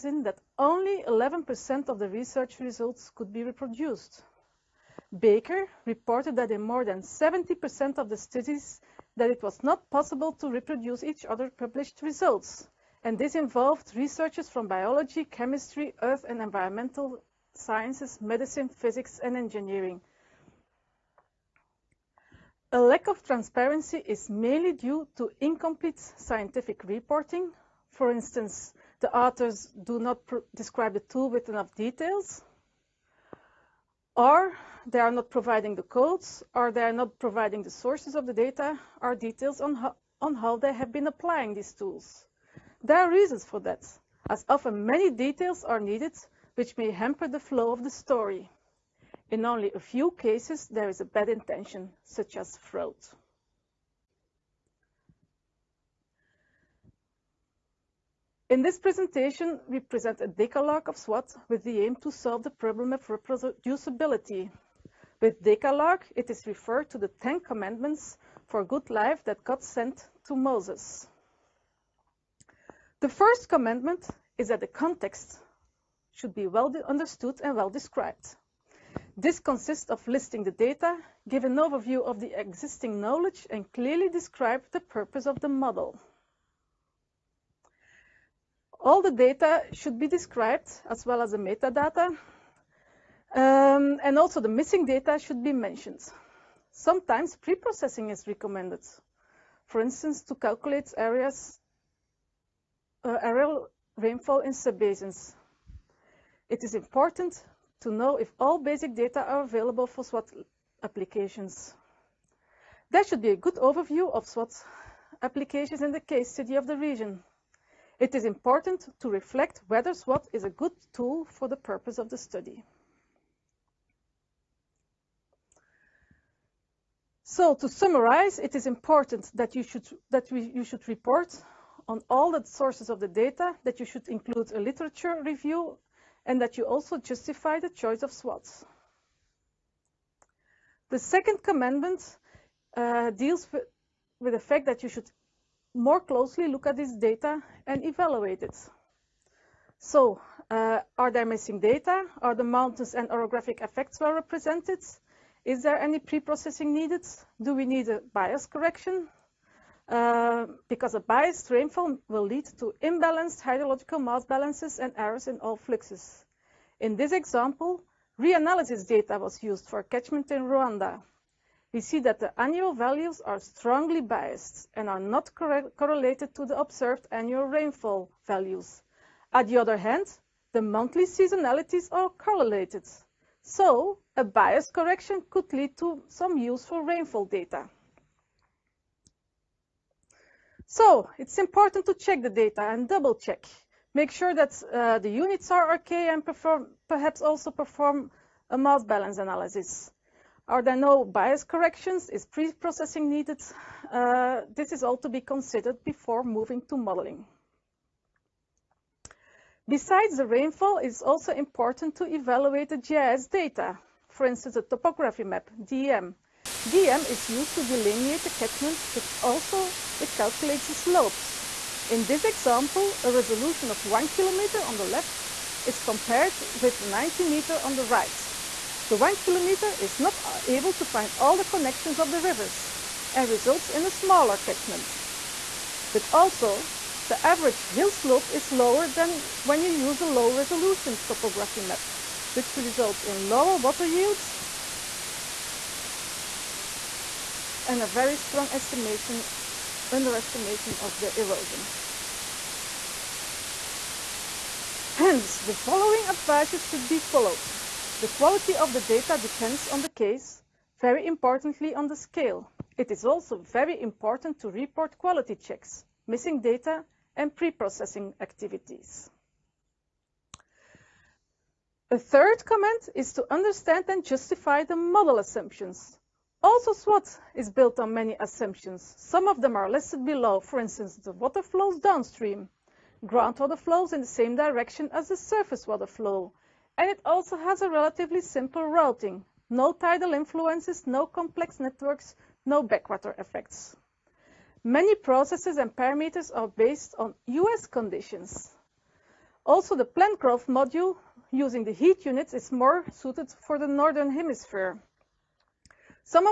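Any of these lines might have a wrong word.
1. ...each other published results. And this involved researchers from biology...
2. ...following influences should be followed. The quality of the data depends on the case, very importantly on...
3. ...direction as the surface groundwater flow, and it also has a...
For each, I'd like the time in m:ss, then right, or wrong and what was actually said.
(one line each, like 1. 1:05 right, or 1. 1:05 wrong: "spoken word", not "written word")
1. 0:11 right
2. 4:15 wrong: "advices", not "influences"
3. 4:44 wrong: "water", not "groundwater".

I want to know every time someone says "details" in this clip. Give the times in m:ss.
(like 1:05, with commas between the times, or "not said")
0:31, 0:39, 0:45.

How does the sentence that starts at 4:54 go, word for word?
Many processes and parameters are based on US conditions.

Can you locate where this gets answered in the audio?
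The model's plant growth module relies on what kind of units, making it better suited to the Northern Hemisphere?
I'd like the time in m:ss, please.
5:01.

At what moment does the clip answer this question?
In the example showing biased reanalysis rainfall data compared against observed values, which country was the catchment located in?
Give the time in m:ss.
2:50.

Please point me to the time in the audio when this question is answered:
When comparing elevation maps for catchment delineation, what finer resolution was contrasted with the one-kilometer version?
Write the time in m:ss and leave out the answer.
3:46.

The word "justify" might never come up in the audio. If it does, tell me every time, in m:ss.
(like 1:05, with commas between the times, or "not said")
2:16, 4:34.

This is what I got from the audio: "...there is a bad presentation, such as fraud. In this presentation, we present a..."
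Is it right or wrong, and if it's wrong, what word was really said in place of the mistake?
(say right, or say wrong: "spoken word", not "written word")
wrong: "intention", not "presentation".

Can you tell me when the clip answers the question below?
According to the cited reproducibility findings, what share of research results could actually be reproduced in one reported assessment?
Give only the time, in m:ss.
0:01.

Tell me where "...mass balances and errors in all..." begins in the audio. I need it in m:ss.
2:44.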